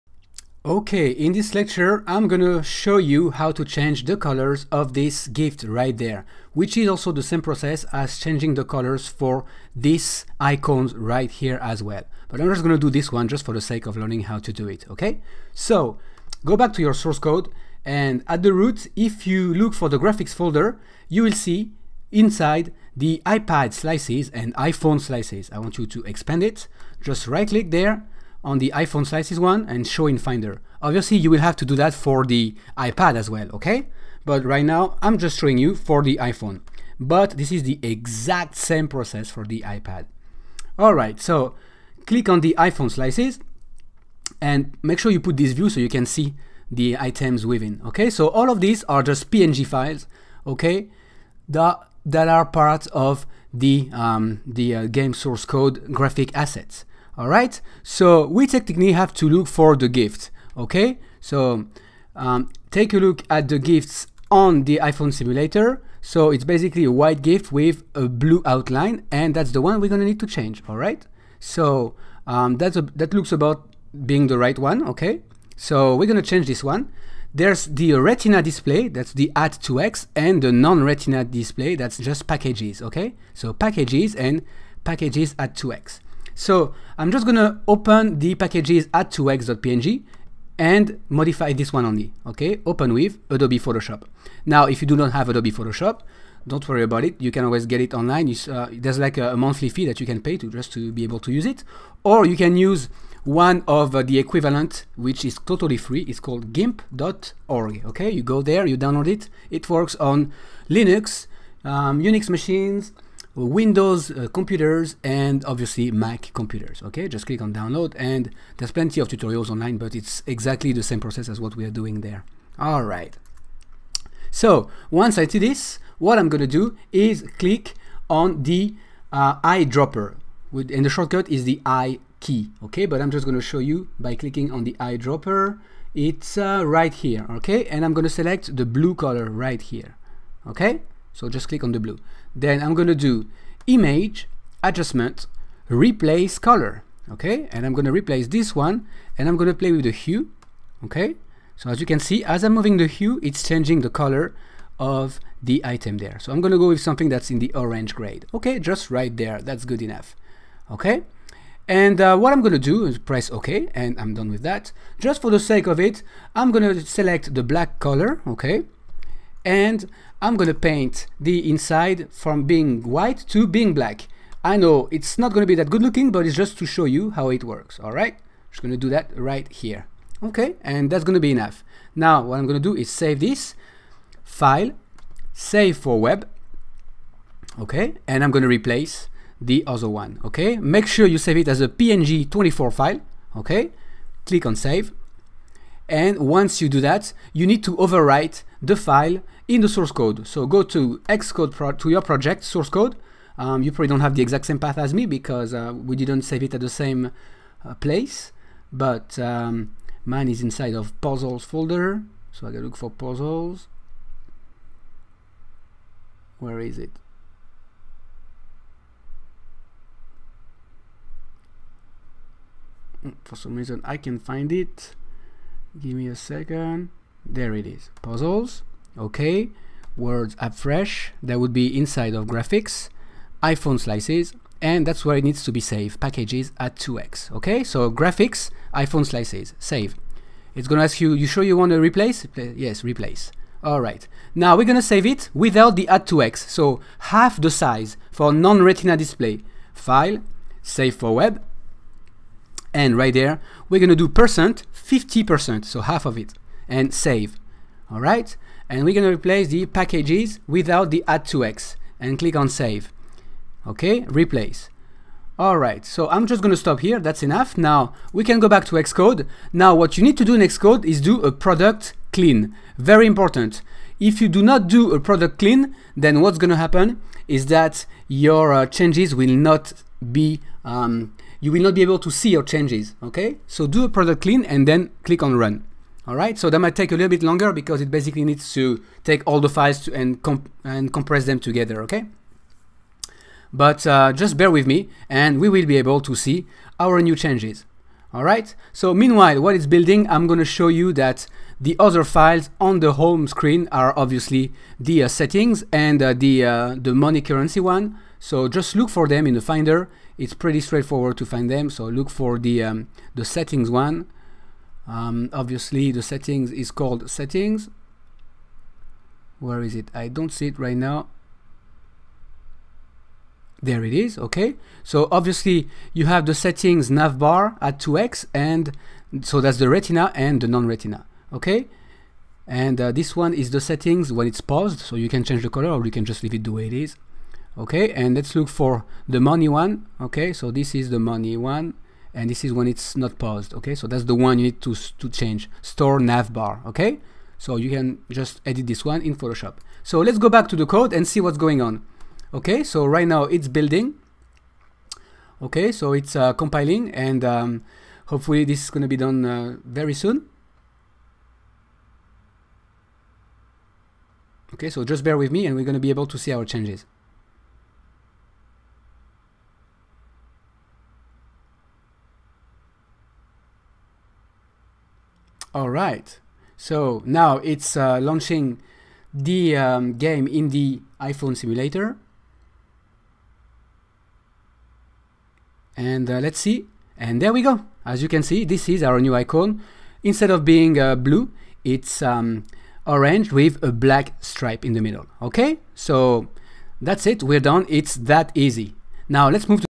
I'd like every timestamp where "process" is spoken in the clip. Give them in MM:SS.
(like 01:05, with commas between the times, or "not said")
00:07, 00:38, 02:00.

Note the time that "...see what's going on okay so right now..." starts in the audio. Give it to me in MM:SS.
05:51.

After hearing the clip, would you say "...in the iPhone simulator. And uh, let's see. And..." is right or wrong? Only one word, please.
right.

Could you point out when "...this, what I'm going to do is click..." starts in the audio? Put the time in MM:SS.
02:05.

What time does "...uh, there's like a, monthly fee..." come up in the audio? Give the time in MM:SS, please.
01:38.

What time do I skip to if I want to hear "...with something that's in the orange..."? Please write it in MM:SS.
02:36.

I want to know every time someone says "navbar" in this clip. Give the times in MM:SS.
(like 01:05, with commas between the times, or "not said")
05:26, 05:45.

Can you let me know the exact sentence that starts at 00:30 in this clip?
Obviously you will have to do that for the iPad as well, okay?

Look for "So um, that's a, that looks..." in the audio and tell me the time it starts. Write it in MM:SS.
01:11.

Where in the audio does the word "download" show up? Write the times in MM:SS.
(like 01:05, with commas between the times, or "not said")
01:48, 01:57.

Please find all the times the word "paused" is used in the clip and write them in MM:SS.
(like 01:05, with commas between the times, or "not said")
05:34, 05:43.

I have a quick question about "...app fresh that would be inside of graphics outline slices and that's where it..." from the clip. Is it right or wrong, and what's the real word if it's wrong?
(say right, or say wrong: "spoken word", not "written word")
wrong: "iphone", not "outline".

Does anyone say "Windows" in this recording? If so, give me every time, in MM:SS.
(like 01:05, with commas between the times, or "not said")
01:53.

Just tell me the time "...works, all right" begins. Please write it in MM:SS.
02:57.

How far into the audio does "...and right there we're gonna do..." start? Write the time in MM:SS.
04:12.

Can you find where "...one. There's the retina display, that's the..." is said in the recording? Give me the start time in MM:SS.
01:16.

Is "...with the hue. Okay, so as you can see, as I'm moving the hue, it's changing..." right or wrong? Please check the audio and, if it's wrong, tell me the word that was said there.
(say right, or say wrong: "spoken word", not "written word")
right.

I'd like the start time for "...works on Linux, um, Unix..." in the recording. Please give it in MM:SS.
01:49.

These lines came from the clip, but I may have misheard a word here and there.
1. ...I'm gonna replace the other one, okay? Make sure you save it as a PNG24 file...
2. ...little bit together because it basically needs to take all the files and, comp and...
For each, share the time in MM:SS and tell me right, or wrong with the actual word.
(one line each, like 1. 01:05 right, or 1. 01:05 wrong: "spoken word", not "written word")
1. 03:08 right
2. 04:46 wrong: "longer", not "together".